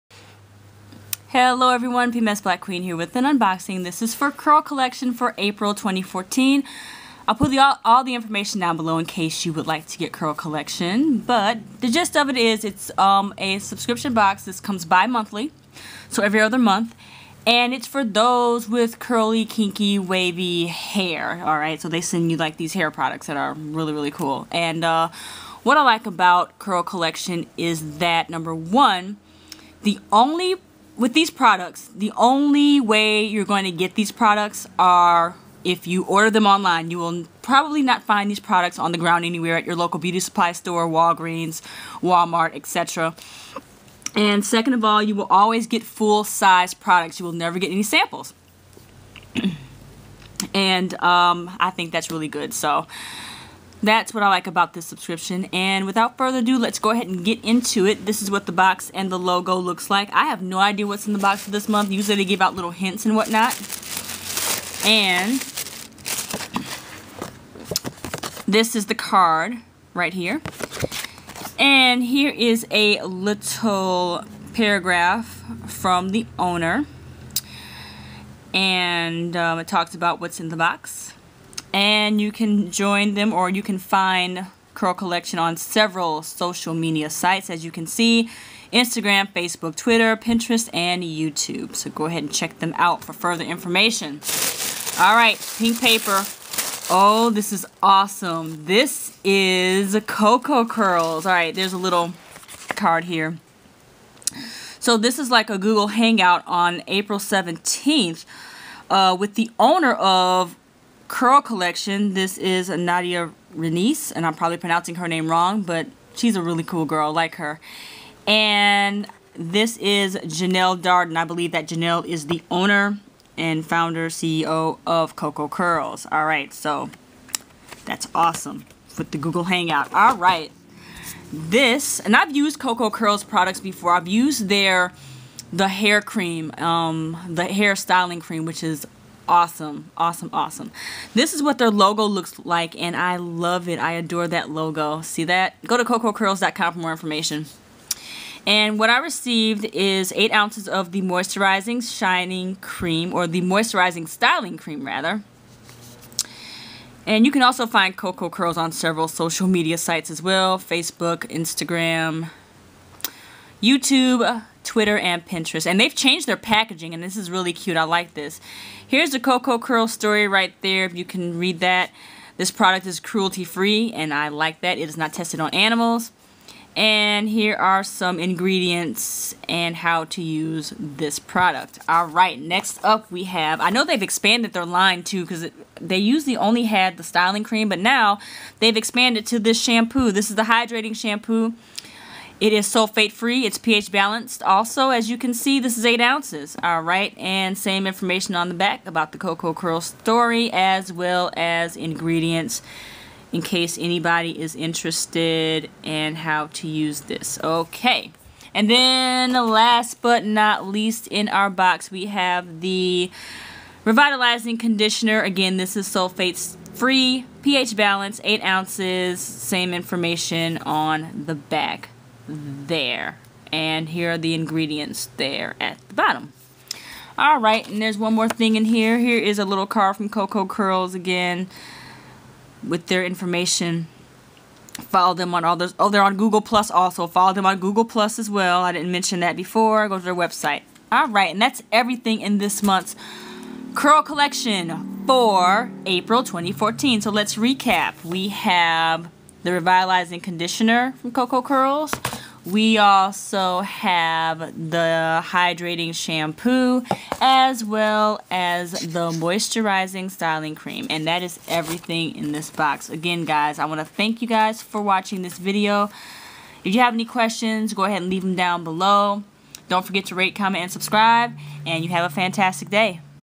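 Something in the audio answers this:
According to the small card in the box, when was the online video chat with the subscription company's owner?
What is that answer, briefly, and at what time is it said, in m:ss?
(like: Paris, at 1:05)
April 17th, at 1:46.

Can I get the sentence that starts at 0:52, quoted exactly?
So, that's what I like about this subscription.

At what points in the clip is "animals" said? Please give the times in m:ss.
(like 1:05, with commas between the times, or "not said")
2:55.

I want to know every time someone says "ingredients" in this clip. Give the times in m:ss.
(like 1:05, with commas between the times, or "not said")
2:58, 3:21, 3:44.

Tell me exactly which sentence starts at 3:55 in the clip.
Oh, they're on Google Plus also.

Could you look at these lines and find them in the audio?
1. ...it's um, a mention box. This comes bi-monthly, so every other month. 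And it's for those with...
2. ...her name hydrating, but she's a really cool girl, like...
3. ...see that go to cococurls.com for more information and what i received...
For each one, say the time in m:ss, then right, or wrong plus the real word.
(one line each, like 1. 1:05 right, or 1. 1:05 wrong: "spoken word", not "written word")
1. 0:12 wrong: "subscription", not "mention"
2. 1:54 wrong: "wrong", not "hydrating"
3. 2:25 right.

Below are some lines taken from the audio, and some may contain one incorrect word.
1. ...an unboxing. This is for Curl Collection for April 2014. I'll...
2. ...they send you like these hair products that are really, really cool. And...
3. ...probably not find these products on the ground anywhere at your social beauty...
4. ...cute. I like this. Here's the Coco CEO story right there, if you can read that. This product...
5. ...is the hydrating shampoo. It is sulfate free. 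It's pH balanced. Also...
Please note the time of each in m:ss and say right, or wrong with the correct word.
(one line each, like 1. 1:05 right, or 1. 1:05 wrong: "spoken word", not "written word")
1. 0:03 right
2. 0:21 right
3. 0:37 wrong: "local", not "social"
4. 2:47 wrong: "Curl", not "CEO"
5. 3:10 right.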